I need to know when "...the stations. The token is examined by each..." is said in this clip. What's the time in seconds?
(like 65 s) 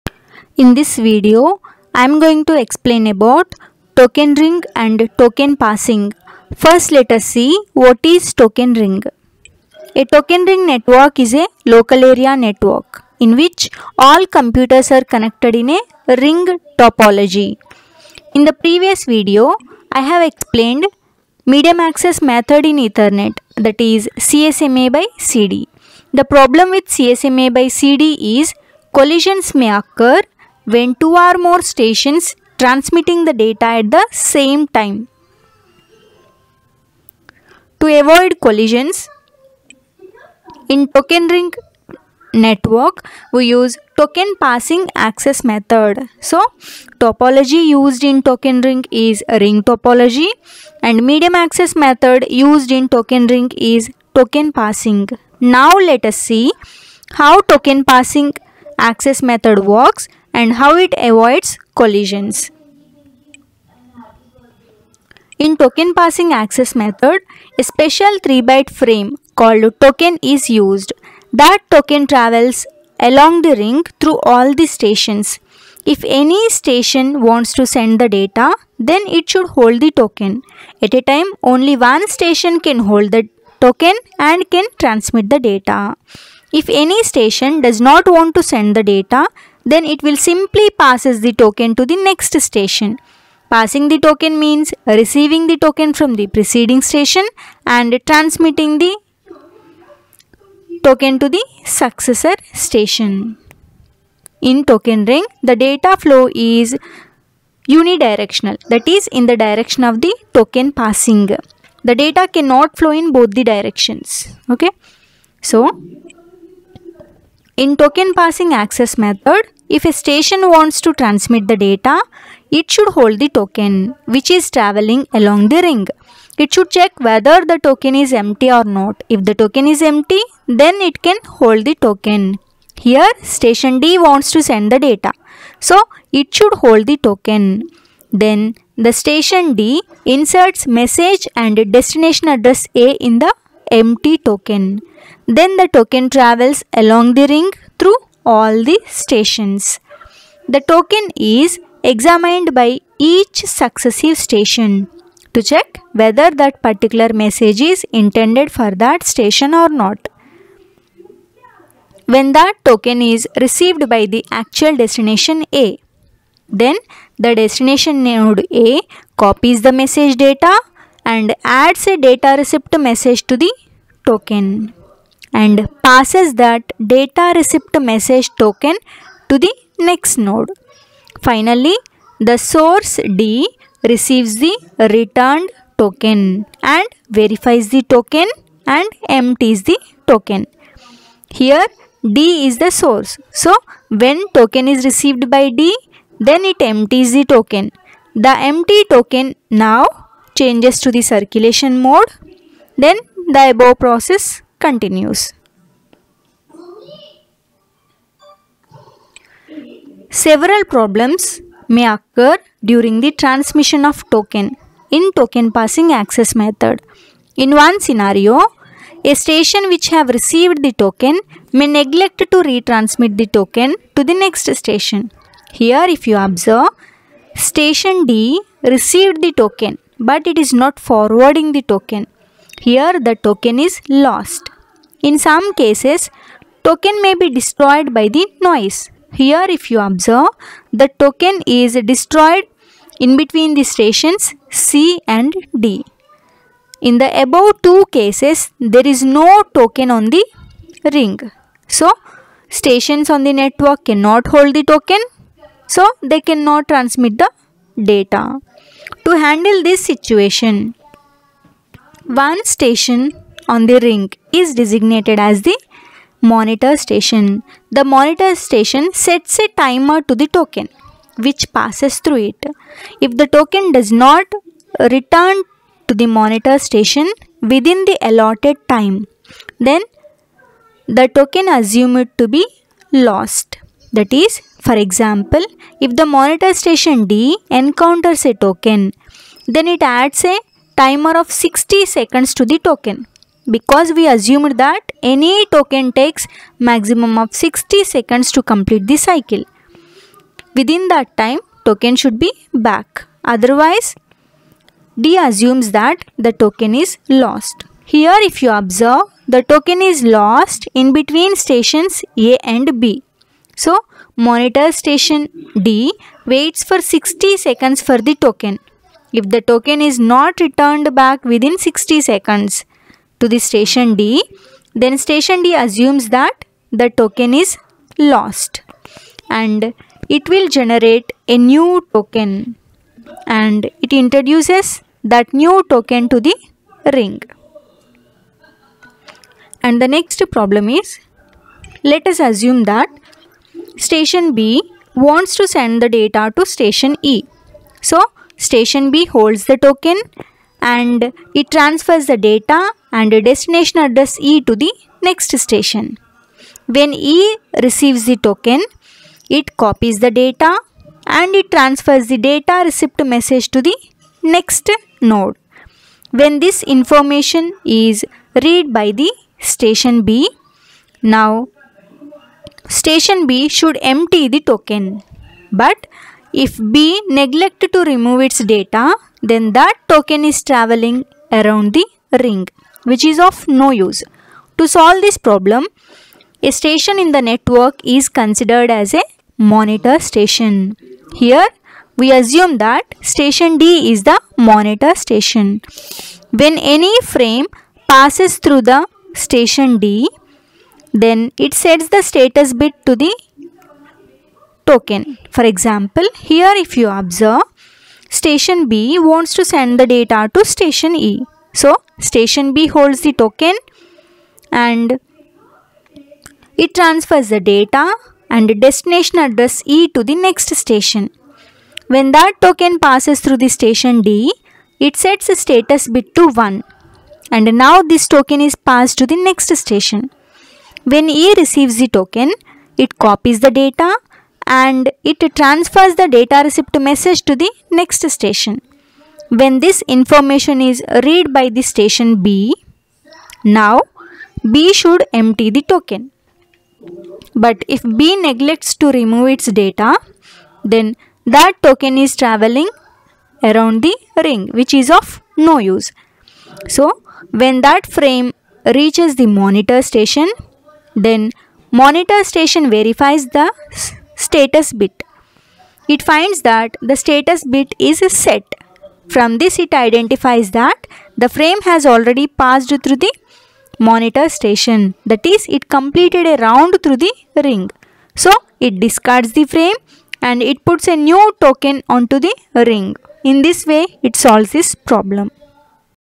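148 s.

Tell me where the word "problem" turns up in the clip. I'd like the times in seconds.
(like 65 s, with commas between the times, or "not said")
26 s, 210 s, 340 s, 385 s, 484 s.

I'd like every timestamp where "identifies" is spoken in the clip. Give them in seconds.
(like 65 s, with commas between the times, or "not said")
469 s.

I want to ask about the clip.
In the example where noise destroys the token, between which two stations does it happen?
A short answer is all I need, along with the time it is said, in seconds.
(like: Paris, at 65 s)
C and D, at 244 s.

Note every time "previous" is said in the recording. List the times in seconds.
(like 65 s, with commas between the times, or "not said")
18 s.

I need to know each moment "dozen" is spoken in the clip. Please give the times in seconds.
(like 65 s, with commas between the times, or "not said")
not said.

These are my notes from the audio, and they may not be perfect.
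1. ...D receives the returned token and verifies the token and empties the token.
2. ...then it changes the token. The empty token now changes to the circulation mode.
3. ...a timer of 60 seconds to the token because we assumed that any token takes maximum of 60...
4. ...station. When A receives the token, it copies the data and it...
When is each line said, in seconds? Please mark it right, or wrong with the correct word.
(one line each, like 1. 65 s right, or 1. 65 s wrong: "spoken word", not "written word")
1. 183 s right
2. 196 s wrong: "empties", not "changes"
3. 290 s right
4. 429 s right.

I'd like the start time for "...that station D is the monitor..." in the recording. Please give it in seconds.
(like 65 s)
392 s.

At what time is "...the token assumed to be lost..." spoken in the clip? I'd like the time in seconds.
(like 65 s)
280 s.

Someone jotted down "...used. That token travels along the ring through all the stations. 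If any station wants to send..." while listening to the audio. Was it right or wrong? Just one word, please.
right.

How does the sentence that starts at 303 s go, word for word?
Otherwise, D assumes that the token is lost.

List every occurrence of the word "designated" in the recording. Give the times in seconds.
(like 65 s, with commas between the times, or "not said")
264 s.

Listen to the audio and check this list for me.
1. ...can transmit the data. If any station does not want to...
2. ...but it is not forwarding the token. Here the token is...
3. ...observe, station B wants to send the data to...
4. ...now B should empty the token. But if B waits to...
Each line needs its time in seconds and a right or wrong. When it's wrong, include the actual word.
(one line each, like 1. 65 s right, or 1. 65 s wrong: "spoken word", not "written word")
1. 84 s right
2. 230 s right
3. 406 s right
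4. 443 s wrong: "neglects", not "waits".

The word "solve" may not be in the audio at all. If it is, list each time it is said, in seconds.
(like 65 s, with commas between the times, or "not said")
384 s, 484 s.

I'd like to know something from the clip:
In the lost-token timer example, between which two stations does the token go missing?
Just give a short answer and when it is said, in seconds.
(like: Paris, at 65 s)
A and B, at 312 s.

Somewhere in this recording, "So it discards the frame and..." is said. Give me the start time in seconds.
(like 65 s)
478 s.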